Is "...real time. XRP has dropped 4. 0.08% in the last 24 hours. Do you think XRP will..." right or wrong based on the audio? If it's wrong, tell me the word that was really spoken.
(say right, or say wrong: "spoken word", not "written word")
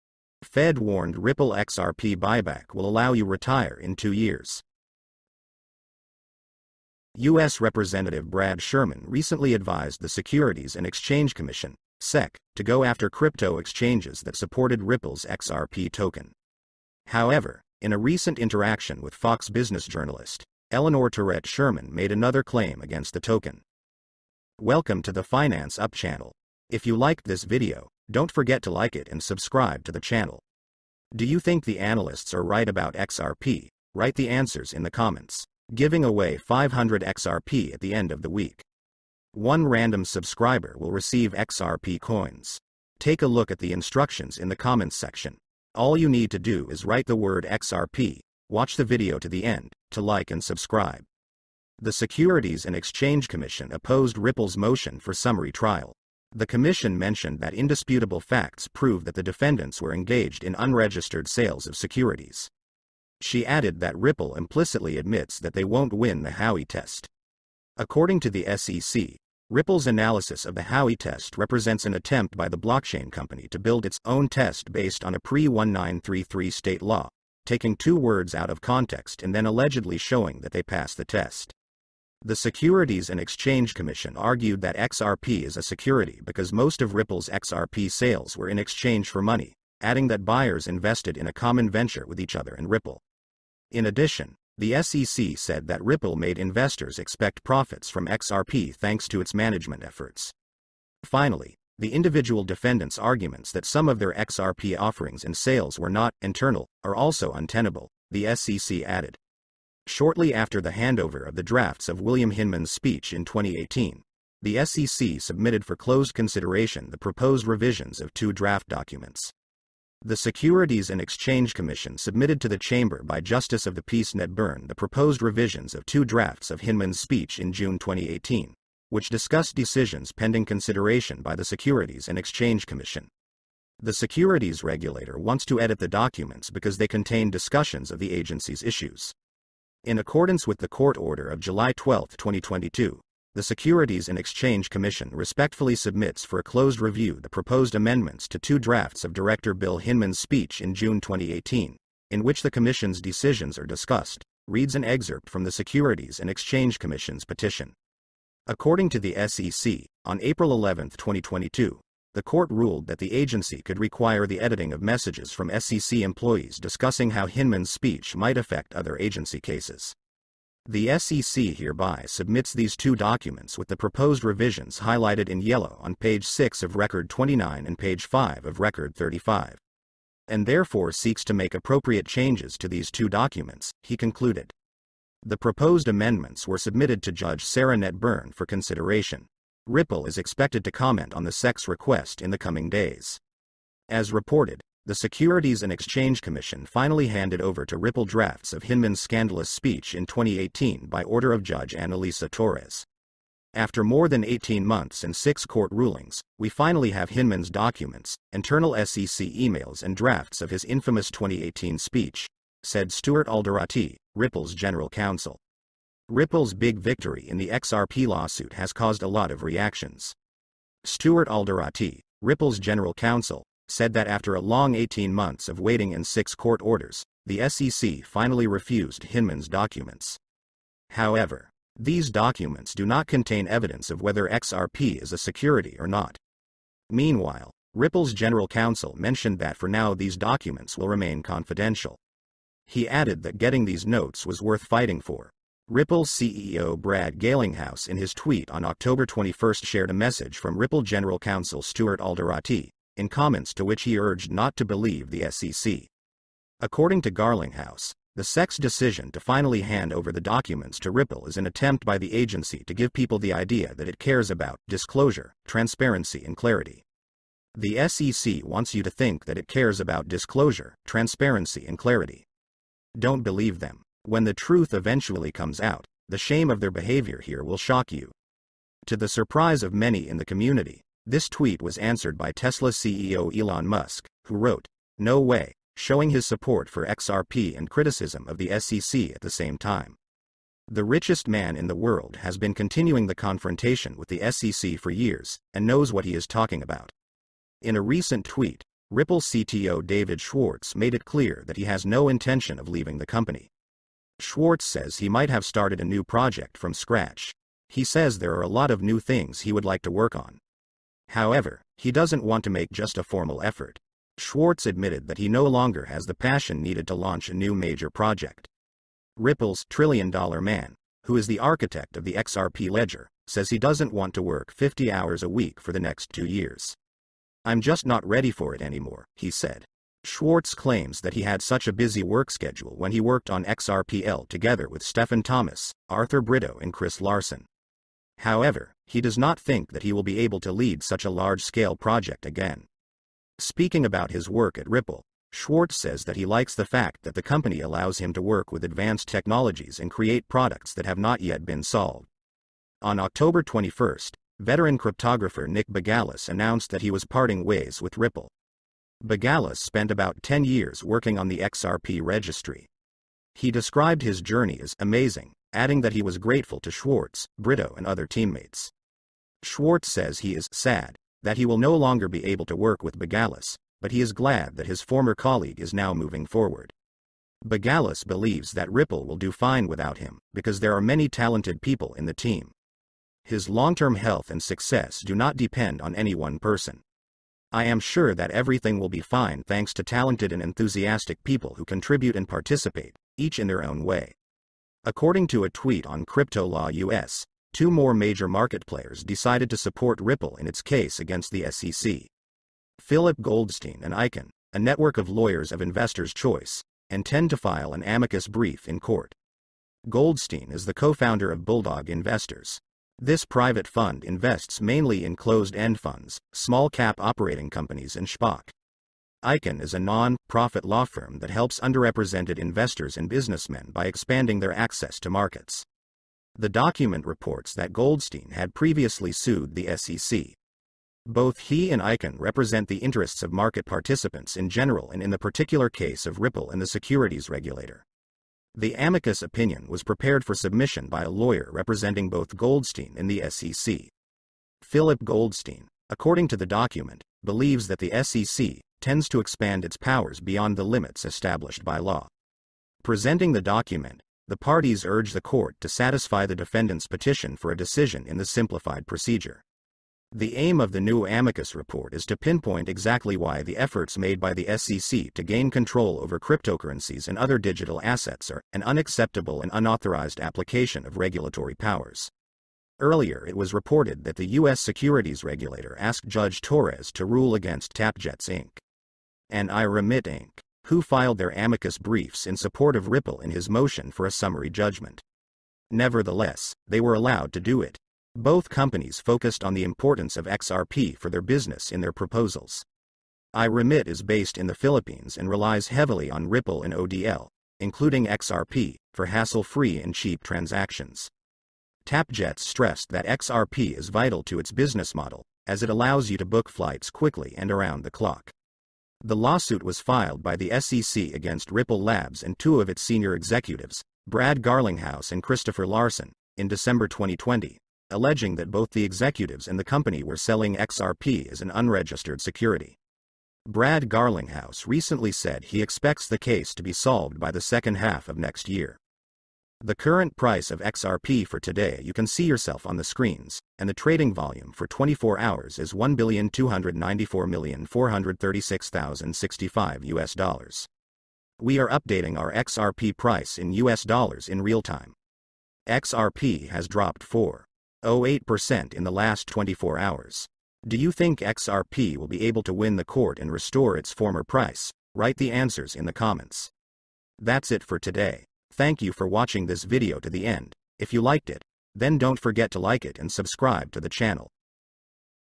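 right.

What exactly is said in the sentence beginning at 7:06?
The document reports that Goldstein had previously sued the SEC.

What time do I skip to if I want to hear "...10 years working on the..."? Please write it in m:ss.
6:00.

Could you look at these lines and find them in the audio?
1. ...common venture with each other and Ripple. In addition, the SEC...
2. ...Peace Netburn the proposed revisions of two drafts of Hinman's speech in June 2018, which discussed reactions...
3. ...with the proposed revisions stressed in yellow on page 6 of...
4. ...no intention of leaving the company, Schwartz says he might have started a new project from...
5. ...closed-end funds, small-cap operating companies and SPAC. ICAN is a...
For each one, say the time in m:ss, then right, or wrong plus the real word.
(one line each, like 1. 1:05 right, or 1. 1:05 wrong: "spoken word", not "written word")
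1. 1:31 right
2. 2:03 wrong: "decisions", not "reactions"
3. 2:53 wrong: "highlighted", not "stressed"
4. 5:01 right
5. 6:55 right.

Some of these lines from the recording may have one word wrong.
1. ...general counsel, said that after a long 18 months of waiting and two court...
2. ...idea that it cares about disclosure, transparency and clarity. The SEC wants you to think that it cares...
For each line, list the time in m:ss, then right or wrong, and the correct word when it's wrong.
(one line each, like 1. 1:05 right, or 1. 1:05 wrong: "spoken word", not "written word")
1. 3:42 wrong: "six", not "two"
2. 4:23 right.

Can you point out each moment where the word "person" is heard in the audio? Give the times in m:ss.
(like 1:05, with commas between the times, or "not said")
6:26.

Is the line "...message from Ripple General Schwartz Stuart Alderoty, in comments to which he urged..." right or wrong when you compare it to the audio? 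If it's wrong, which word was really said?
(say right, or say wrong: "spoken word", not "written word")
wrong: "Counsel", not "Schwartz".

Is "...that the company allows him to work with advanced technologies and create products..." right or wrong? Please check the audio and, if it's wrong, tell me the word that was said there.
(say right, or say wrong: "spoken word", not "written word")
right.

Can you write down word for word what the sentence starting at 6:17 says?
Bougalis believes that Ripple will do fine without him because there are many talented people in the team.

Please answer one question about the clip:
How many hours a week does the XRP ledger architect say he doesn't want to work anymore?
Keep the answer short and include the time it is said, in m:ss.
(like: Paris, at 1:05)
50, at 5:24.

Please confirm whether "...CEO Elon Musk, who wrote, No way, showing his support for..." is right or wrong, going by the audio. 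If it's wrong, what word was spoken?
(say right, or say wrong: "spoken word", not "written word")
right.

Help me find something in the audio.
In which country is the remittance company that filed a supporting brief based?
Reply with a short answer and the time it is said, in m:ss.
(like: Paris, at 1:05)
Philippines, at 8:14.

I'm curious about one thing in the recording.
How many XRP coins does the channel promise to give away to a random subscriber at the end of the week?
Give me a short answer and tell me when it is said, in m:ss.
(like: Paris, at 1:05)
500, at 0:36.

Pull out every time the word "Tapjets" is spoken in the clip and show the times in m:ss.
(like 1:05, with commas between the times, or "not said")
7:57, 8:21.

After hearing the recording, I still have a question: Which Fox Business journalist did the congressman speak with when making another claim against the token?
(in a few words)
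Eleanor Terrett.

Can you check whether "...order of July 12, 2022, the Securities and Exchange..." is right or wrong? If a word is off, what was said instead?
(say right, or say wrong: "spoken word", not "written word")
right.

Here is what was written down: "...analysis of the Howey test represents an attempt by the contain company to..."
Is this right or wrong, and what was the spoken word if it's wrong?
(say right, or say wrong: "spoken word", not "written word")
wrong: "blockchain", not "contain".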